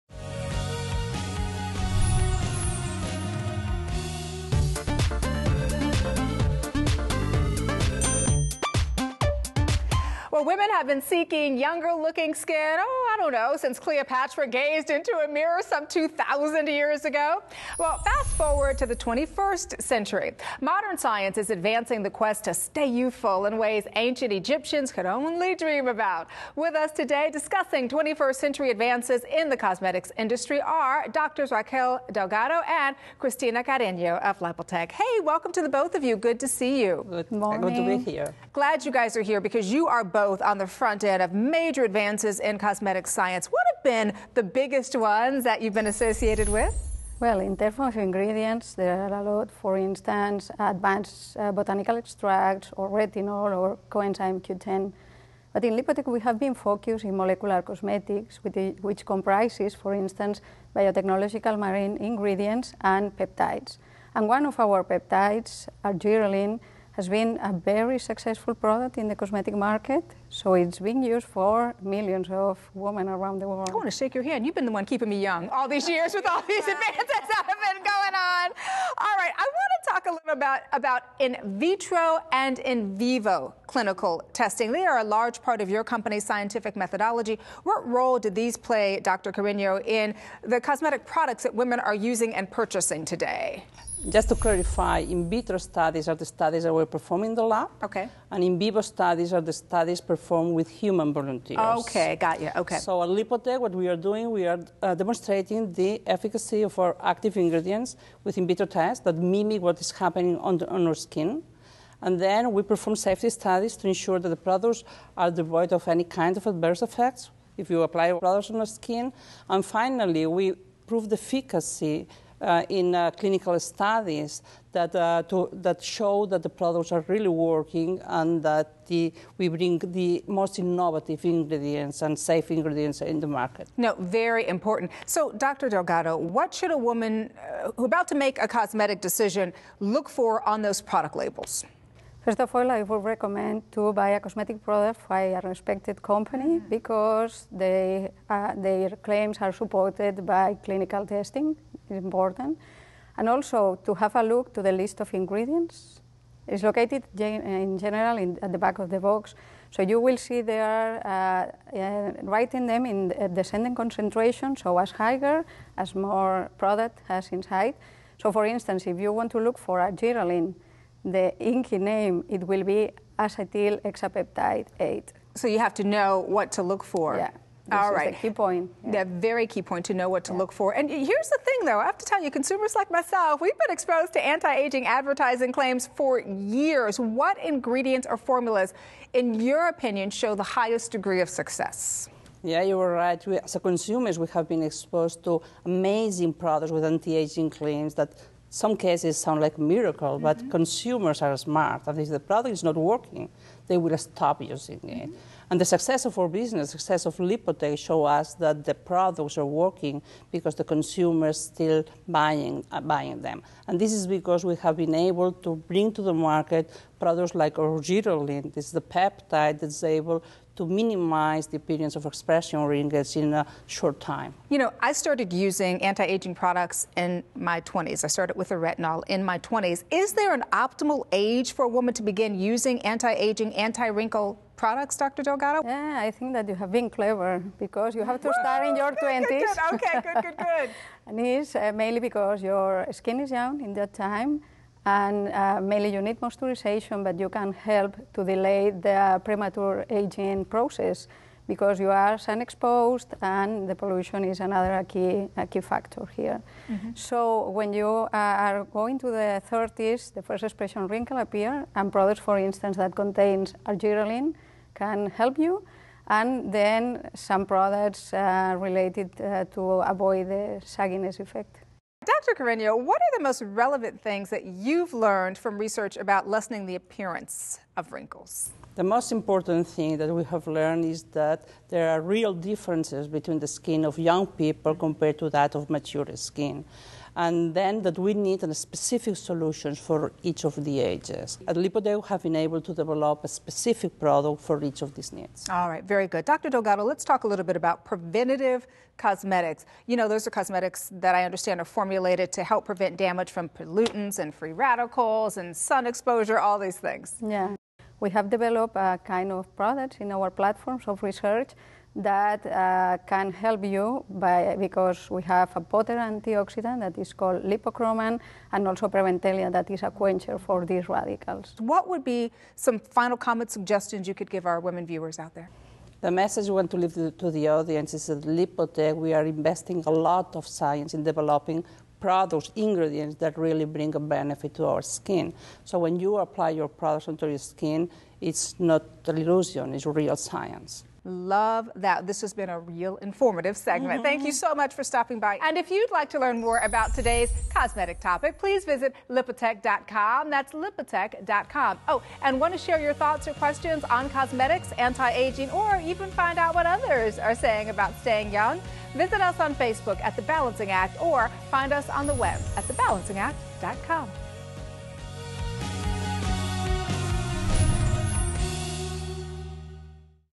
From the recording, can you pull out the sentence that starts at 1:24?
They are a large part of your company's scientific methodology.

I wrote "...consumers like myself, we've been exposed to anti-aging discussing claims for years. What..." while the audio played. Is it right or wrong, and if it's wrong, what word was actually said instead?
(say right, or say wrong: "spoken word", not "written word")
wrong: "advertising", not "discussing".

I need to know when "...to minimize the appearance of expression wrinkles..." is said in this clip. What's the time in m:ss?
3:40.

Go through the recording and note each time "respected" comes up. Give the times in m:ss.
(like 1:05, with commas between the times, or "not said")
2:25.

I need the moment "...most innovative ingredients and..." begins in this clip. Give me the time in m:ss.
2:10.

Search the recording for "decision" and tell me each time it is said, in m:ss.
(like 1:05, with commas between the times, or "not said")
2:19.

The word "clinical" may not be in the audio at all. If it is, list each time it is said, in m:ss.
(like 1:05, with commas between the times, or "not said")
1:23, 2:03, 2:30.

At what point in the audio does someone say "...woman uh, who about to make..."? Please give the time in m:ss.
2:16.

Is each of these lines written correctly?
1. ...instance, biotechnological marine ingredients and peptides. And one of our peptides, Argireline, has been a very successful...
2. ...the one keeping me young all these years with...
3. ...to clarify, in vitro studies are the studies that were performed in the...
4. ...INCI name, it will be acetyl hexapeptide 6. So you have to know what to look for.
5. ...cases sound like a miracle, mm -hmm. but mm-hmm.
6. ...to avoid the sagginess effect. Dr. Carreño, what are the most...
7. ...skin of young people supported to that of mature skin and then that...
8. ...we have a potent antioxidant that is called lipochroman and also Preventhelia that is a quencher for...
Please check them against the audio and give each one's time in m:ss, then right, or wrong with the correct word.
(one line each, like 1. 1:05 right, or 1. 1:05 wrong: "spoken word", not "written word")
1. 0:59 right
2. 1:14 right
3. 1:34 right
4. 2:51 wrong: "8", not "6"
5. 3:18 right
6. 4:29 right
7. 4:43 wrong: "compared", not "supported"
8. 5:15 right.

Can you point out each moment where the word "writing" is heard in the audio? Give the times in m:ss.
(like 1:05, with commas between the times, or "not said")
2:42.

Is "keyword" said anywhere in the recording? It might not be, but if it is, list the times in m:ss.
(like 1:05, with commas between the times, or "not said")
not said.